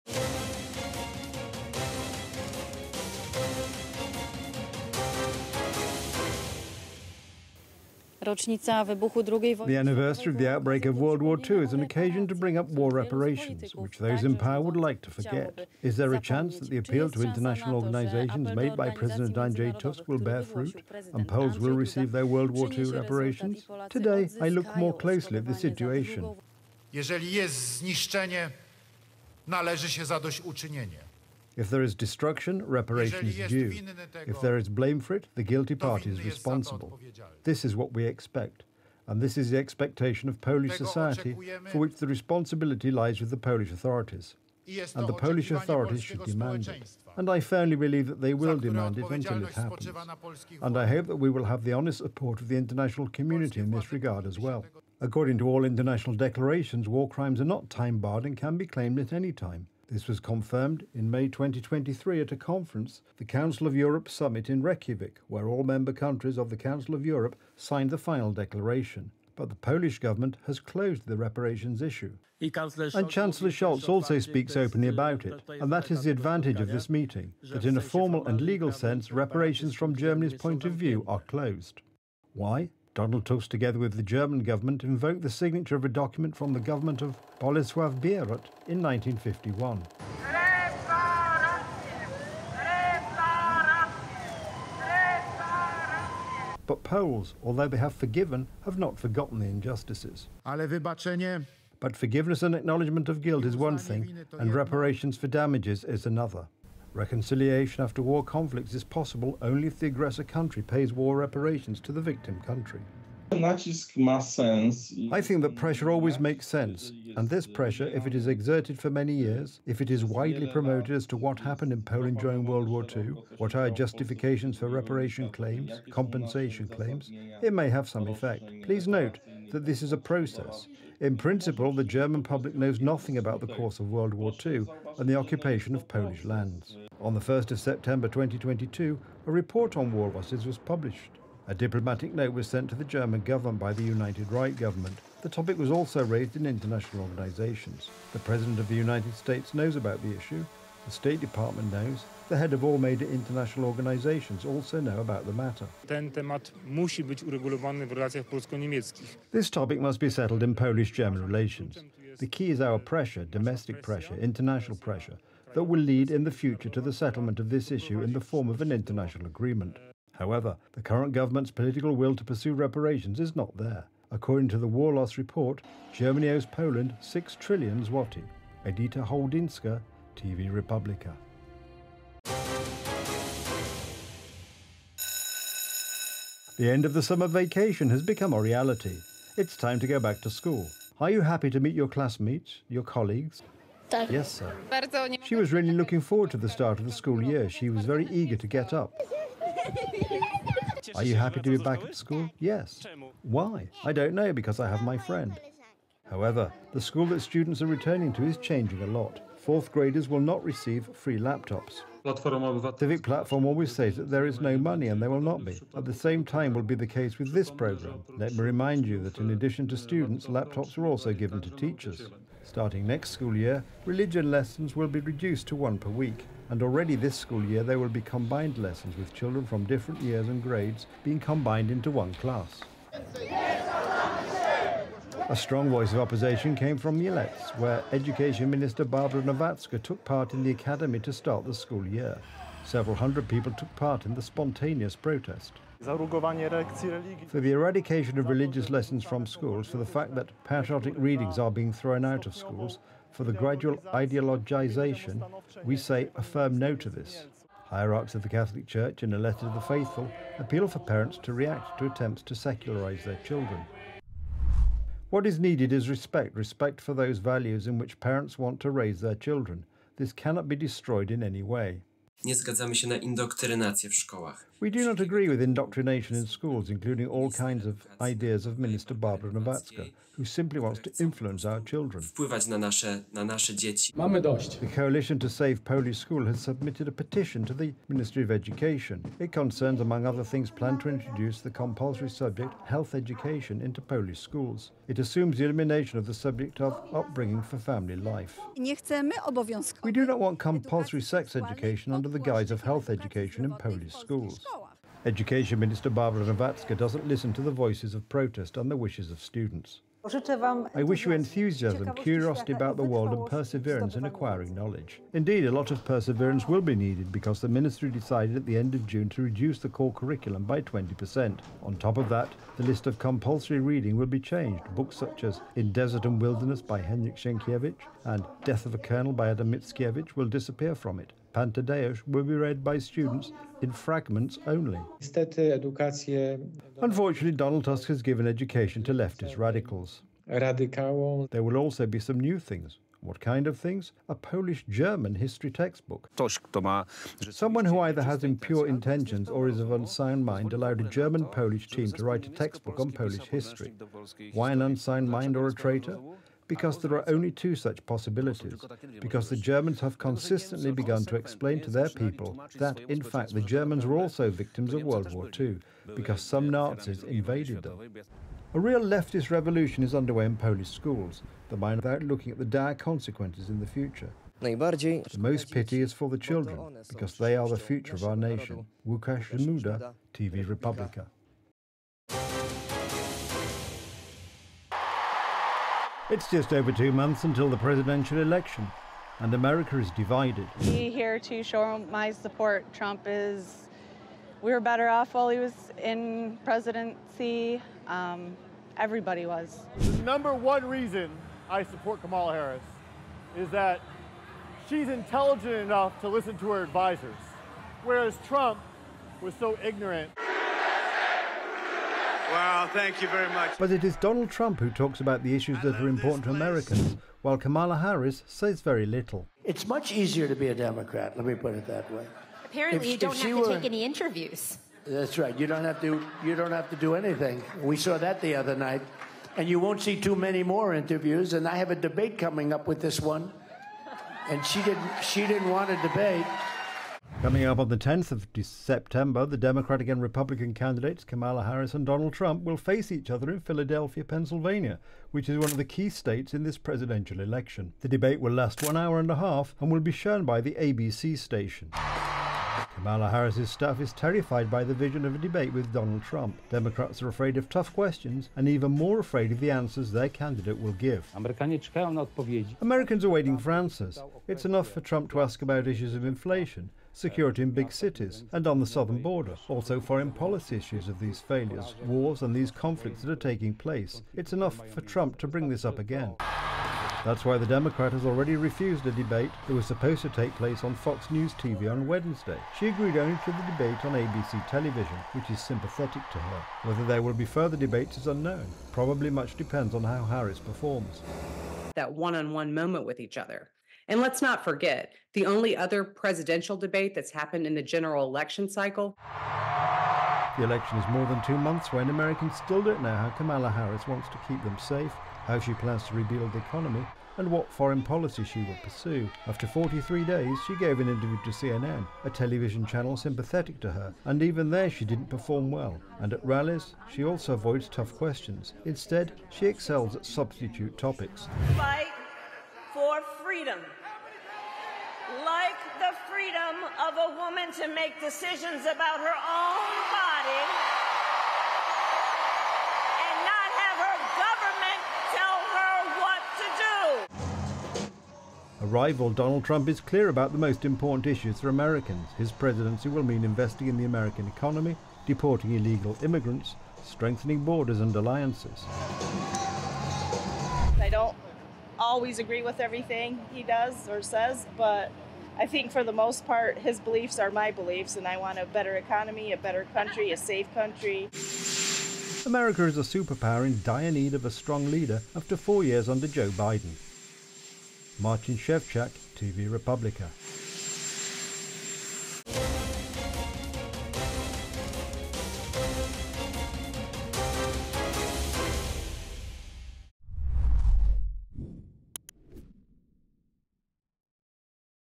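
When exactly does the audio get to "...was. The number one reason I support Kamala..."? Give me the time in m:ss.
6:39.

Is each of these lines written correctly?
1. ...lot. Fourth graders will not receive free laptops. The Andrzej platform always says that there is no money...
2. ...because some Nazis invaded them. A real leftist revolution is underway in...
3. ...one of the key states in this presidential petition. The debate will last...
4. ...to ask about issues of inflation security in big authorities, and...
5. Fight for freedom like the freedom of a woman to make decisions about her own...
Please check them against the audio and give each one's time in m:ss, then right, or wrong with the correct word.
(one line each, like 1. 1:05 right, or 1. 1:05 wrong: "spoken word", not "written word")
1. 3:28 wrong: "Civic", not "Andrzej"
2. 6:05 right
3. 7:25 wrong: "election", not "petition"
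4. 7:45 wrong: "cities", not "authorities"
5. 8:41 right.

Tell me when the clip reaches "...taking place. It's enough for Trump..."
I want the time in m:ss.
7:53.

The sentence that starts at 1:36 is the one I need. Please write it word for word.
But Poles, although they have forgiven, have not forgotten the injustices.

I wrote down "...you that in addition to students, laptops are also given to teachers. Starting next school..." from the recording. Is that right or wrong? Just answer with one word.
right.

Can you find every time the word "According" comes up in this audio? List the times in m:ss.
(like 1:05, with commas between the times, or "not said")
0:54, 2:54.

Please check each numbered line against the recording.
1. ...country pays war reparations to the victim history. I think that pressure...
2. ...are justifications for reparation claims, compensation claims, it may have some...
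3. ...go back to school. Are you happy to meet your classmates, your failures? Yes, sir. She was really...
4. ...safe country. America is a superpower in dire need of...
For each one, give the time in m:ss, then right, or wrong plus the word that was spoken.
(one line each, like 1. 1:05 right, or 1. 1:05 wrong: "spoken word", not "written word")
1. 1:50 wrong: "country", not "history"
2. 2:03 right
3. 3:09 wrong: "colleagues", not "failures"
4. 9:20 right.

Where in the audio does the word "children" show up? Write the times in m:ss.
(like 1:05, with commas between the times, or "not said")
3:49, 4:23, 4:29, 4:41, 6:16.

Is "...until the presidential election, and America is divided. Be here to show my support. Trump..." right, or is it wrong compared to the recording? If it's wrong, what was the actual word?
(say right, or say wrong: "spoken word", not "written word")
right.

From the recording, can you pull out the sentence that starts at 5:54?
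Why an unsound mind or a traitor?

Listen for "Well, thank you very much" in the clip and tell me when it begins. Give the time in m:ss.
6:52.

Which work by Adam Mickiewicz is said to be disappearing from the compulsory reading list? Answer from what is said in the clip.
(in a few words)
Death of a Colonel.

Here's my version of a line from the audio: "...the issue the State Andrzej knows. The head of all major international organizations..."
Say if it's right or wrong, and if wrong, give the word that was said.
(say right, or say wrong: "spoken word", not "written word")
wrong: "Department", not "Andrzej".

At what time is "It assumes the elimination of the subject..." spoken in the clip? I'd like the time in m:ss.
4:54.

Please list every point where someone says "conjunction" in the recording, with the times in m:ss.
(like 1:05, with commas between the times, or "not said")
not said.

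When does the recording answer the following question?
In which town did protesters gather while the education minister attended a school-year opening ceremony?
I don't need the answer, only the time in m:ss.
3:56.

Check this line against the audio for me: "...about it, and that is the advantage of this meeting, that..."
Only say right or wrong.
right.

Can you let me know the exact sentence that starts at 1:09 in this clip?
But the Polish government has closed the reparations issue.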